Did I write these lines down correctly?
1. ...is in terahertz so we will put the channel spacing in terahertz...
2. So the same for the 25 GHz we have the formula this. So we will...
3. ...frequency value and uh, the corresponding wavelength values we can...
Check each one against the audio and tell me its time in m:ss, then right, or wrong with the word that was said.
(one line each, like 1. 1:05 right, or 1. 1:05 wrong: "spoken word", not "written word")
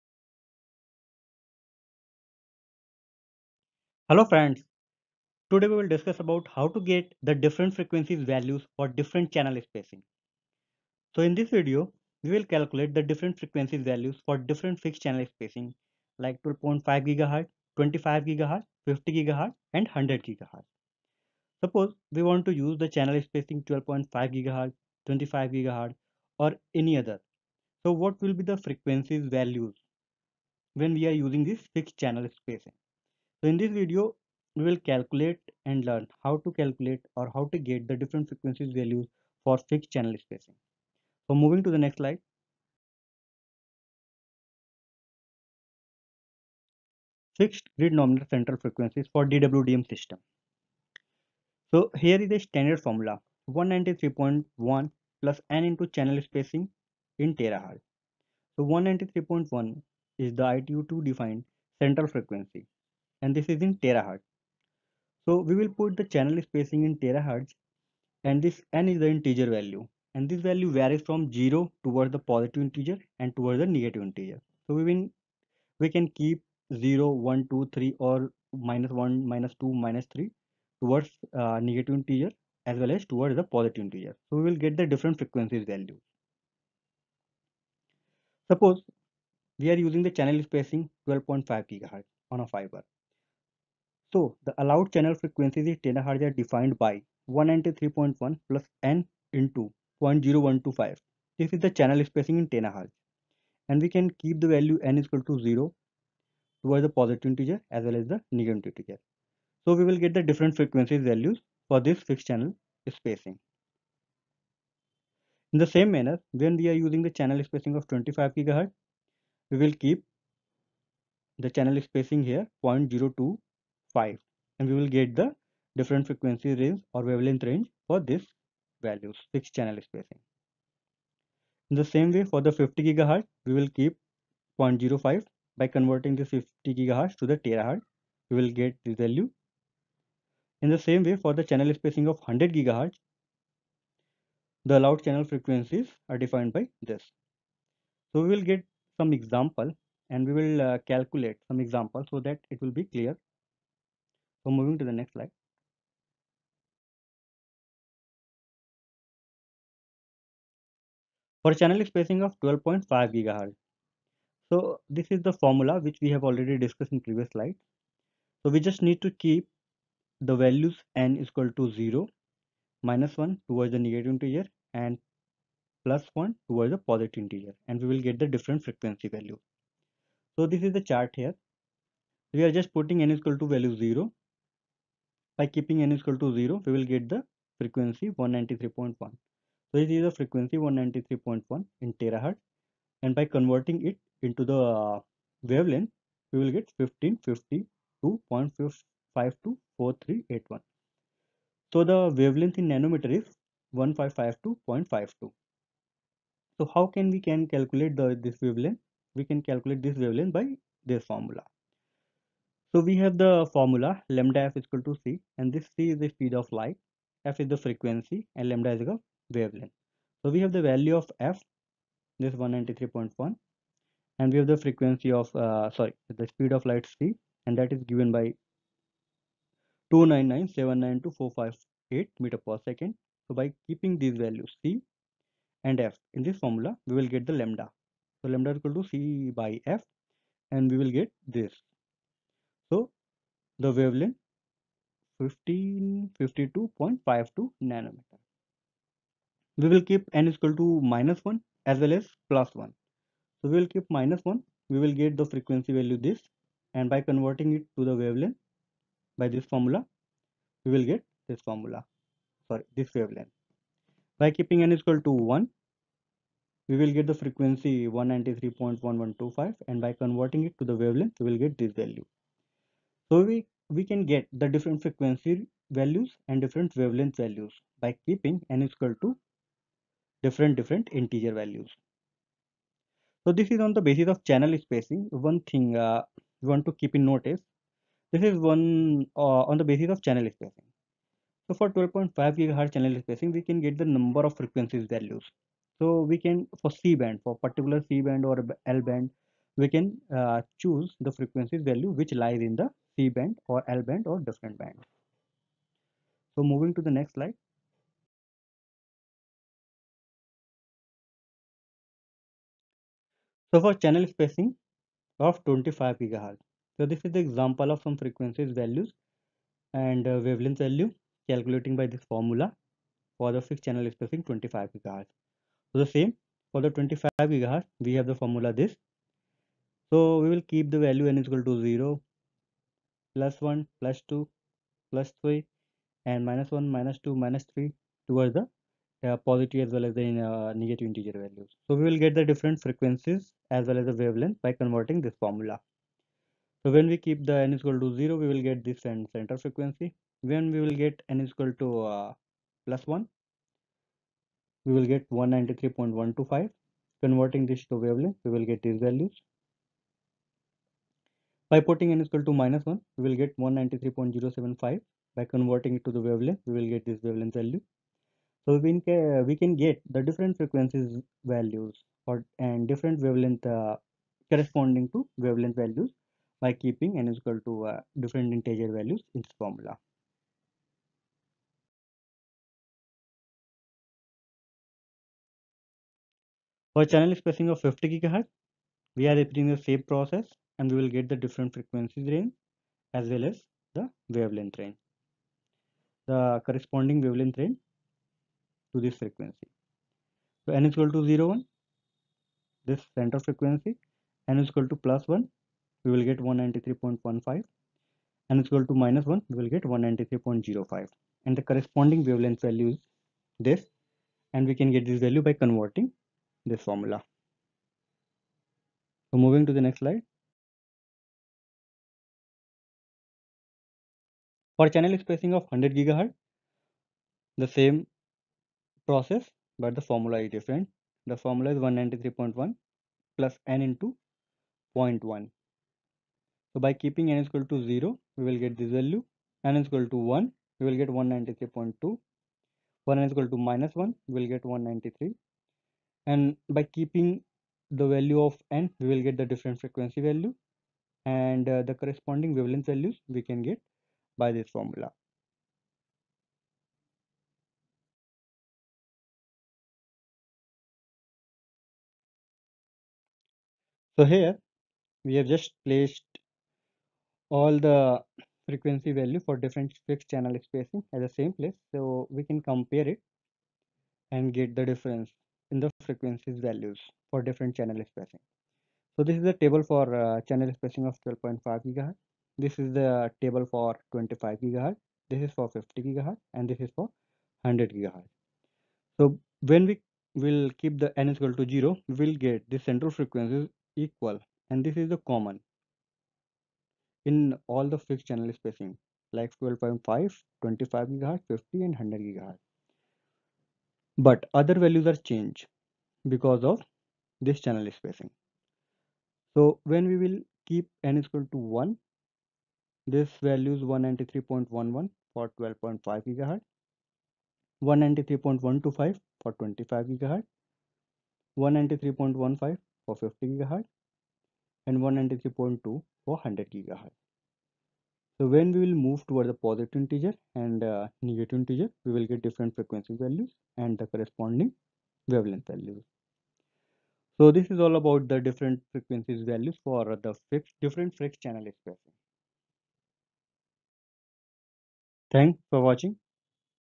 1. 1:03 right
2. 5:25 right
3. 7:29 right.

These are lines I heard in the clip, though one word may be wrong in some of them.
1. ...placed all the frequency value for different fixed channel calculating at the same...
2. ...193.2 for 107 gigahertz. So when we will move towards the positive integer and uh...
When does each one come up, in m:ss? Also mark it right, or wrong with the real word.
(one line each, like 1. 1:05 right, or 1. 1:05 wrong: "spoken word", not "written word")
1. 7:45 wrong: "spacing", not "calculating"
2. 8:44 wrong: "100", not "107".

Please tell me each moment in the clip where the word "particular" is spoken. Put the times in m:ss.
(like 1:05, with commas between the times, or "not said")
4:57.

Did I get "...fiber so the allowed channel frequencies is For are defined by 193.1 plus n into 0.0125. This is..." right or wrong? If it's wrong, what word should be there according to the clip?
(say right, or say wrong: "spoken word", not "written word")
wrong: "THz", not "For".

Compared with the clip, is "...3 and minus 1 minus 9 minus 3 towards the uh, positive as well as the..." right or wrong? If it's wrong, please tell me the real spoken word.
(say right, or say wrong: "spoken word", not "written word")
wrong: "2", not "9".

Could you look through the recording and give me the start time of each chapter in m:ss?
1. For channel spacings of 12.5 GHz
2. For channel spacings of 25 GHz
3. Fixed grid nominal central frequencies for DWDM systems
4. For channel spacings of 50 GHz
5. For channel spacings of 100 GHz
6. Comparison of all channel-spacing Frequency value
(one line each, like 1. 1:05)
1. 2:41
2. 5:13
3. 0:45
4. 6:26
5. 7:04
6. 7:43.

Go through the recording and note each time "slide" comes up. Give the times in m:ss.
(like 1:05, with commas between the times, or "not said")
0:41, 2:35, 2:47, 5:07, 6:59.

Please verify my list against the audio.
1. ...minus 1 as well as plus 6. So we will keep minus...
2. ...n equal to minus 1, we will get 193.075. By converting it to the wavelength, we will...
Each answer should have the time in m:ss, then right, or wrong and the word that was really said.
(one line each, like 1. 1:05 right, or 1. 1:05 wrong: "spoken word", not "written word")
1. 4:10 wrong: "1", not "6"
2. 6:01 right.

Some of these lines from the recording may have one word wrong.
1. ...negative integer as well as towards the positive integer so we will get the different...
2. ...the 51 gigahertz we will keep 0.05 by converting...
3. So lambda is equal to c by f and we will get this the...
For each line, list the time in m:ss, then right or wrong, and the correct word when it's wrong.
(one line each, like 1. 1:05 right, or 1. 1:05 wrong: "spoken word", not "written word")
1. 1:21 right
2. 2:12 wrong: "50", not "51"
3. 3:58 right.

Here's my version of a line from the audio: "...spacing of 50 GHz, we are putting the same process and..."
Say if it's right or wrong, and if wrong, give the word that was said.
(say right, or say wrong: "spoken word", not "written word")
wrong: "repeating", not "putting".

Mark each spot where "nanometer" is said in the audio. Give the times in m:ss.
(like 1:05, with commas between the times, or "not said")
3:22, 4:07.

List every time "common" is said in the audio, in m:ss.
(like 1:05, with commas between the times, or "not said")
8:15.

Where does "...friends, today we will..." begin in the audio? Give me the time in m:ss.
0:04.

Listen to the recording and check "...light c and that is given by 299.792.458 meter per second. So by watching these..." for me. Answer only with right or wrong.
wrong.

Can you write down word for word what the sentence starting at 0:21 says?
Suppose we want to use the channel spacing 12.5 GHz, 25 GHz or any other.